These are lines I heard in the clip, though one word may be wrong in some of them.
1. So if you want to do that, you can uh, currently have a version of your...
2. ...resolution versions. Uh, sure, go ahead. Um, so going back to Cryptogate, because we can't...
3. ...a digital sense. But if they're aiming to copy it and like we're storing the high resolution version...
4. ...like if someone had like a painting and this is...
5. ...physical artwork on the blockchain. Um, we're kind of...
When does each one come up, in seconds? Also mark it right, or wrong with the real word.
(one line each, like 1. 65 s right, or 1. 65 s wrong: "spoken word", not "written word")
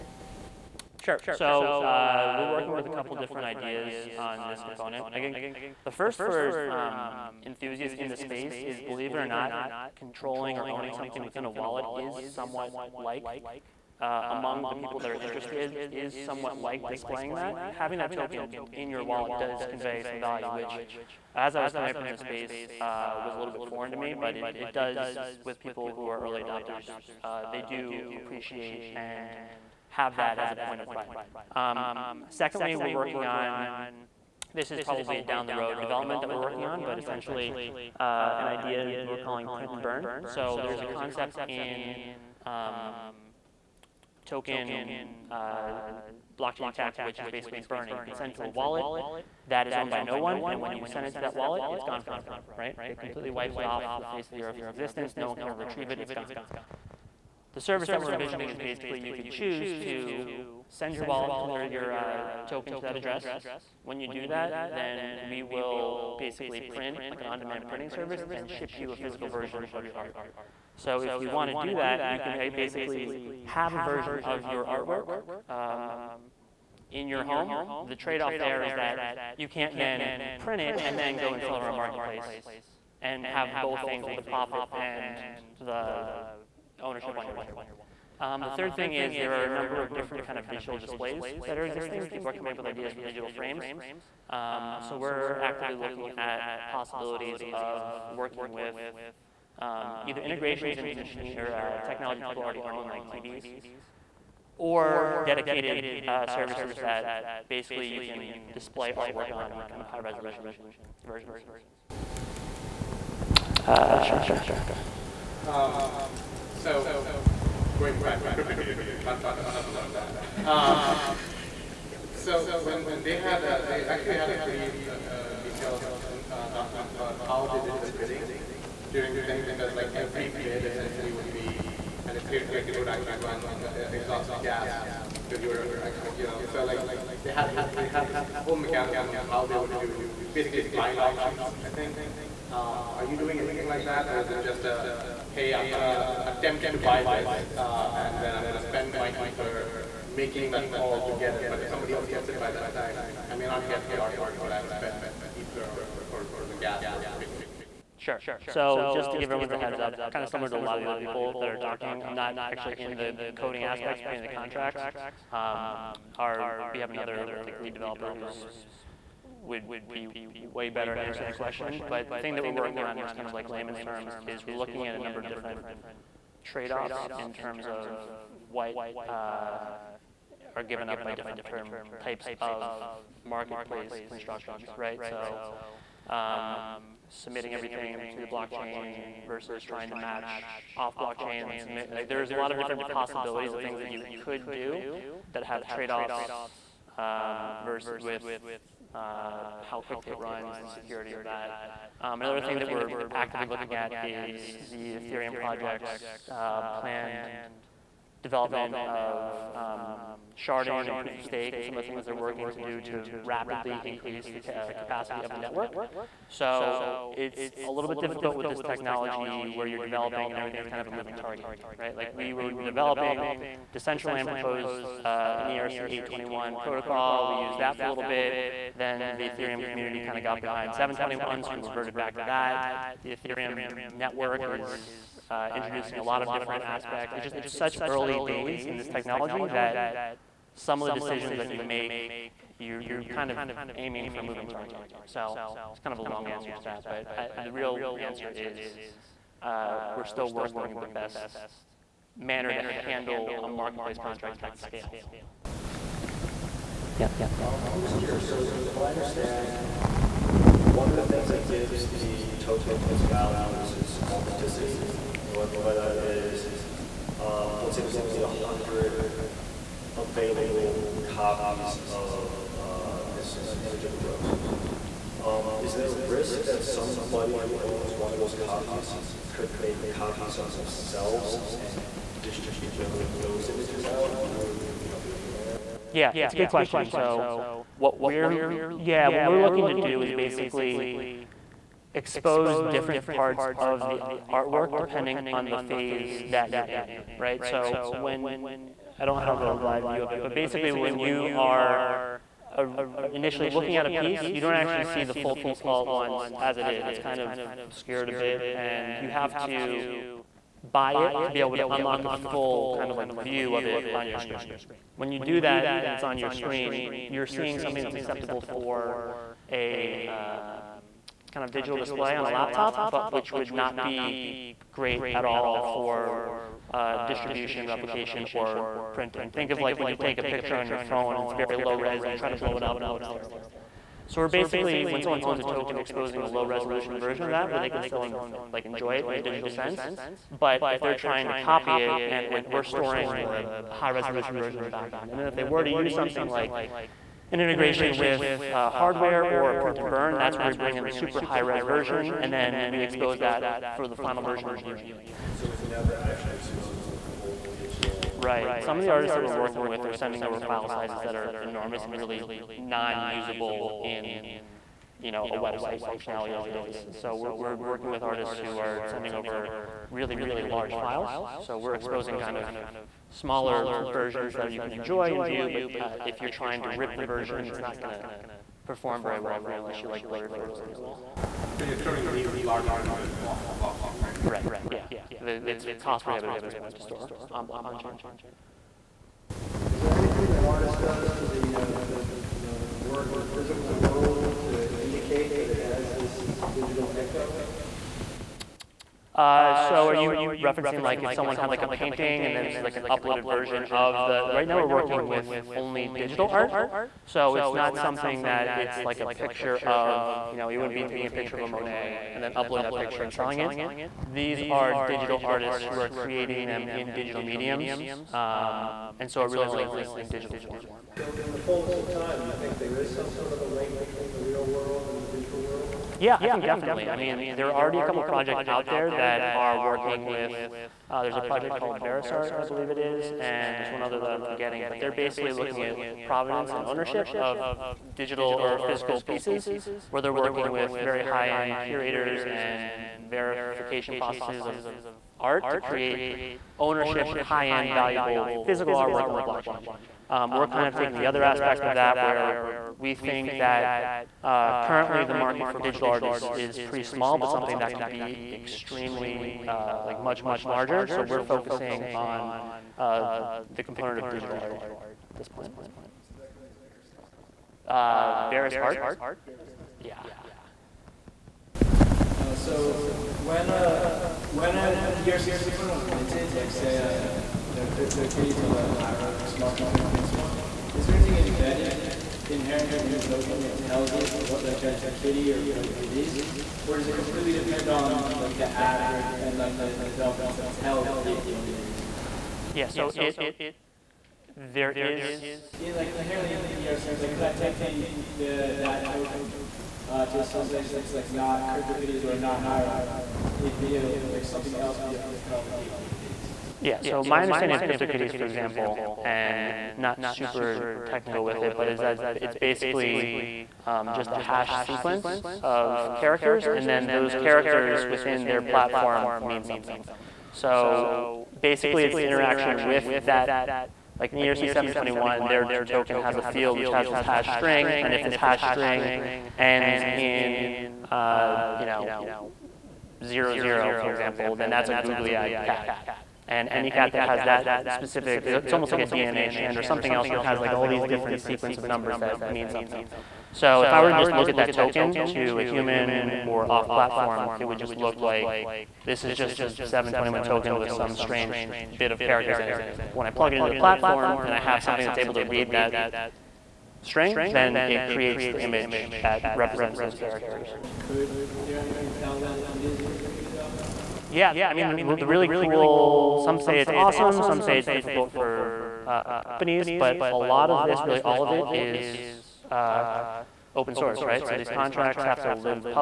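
1. 70 s wrong: "basically", not "currently"
2. 109 s right
3. 339 s wrong: "trying", not "aiming"
4. 400 s right
5. 448 s right.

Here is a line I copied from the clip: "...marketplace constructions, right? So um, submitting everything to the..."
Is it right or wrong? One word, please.
right.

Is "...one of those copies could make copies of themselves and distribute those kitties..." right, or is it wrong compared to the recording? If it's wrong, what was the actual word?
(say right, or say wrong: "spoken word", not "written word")
wrong: "images", not "kitties".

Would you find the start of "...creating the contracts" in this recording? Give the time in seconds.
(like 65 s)
164 s.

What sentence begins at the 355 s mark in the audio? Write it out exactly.
So it never actually exposes the full digital.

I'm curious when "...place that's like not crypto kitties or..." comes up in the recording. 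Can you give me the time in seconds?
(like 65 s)
500 s.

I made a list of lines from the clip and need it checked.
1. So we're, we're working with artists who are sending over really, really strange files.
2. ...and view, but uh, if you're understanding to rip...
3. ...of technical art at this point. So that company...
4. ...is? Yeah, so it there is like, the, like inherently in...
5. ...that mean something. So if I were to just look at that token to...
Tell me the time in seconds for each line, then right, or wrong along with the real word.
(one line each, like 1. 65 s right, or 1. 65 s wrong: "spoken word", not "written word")
1. 366 s wrong: "large", not "strange"
2. 375 s wrong: "trying", not "understanding"
3. 463 s wrong: "digital", not "technical"
4. 491 s right
5. 541 s right.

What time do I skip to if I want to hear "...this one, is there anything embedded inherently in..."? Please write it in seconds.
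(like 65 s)
479 s.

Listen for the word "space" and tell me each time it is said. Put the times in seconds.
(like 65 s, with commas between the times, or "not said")
8 s, 22 s.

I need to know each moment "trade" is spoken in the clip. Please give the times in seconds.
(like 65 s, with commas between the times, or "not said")
77 s, 176 s, 195 s.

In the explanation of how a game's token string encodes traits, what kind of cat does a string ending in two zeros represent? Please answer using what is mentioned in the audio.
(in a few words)
googly-eyed cat.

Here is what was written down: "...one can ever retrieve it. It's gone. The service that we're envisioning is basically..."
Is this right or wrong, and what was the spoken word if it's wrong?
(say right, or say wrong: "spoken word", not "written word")
right.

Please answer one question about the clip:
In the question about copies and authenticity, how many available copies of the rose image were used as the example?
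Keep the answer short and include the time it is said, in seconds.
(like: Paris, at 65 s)
100, at 268 s.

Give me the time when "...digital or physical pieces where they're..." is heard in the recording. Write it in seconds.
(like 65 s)
437 s.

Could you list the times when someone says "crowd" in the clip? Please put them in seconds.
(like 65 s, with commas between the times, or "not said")
not said.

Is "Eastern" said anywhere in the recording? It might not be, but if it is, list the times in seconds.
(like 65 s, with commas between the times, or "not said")
not said.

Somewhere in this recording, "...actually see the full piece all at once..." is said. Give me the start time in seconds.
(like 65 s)
304 s.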